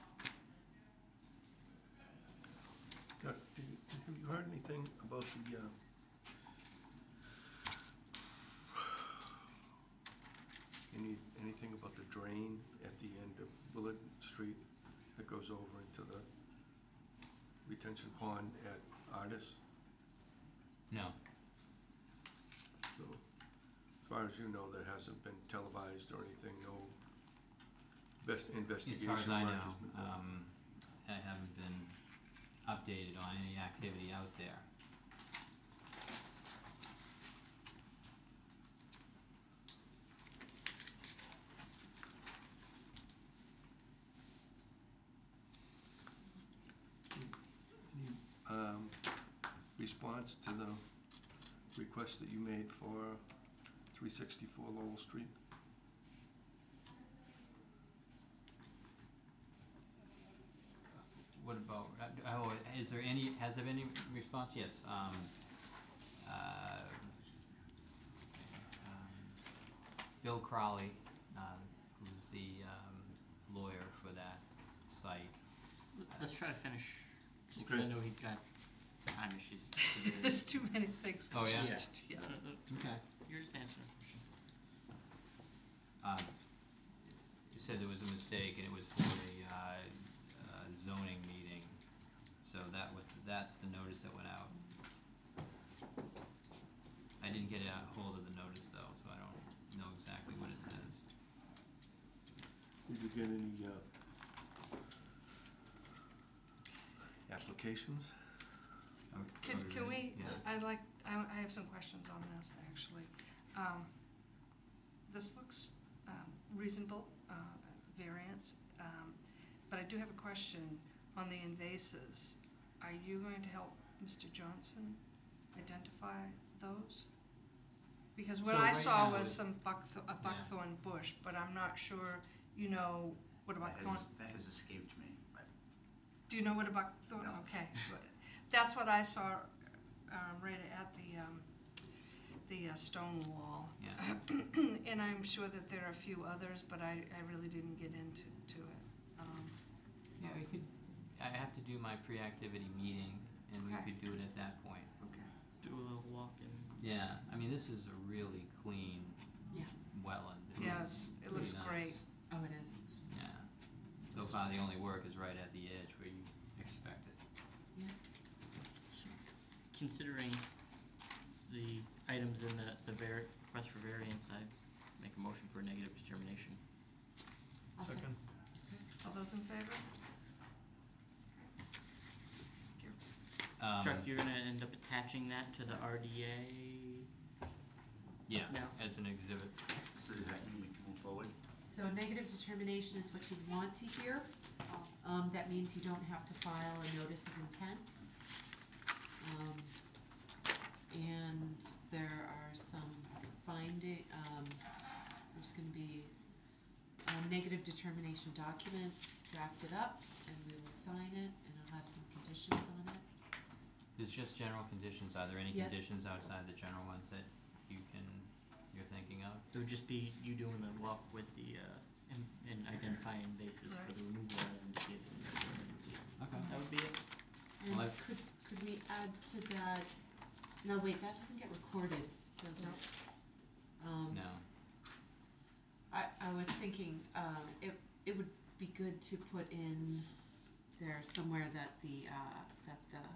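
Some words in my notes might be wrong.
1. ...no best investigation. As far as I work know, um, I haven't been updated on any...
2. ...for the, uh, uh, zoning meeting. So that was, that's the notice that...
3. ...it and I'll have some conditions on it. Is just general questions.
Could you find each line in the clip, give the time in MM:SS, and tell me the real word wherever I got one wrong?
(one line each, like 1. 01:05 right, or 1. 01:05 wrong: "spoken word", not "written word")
1. 00:26 right
2. 01:28 right
3. 03:31 wrong: "conditions", not "questions".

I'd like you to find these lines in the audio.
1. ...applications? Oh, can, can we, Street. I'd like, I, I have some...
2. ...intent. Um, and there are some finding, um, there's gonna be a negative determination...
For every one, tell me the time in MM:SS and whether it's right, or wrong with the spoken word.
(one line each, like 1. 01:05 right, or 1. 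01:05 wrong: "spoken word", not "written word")
1. 01:47 wrong: "Yeah", not "Street"
2. 03:17 right.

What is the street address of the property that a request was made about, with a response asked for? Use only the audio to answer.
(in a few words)
364 Lowell Street.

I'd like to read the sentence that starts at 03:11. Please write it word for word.
So negative determination is what you want to hear.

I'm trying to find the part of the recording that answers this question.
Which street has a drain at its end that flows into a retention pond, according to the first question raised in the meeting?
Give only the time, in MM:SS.
00:13.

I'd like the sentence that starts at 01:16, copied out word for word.
Let's try to finish, because I know he's got time issues.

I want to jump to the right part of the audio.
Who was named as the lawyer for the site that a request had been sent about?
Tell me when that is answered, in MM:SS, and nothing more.
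01:10.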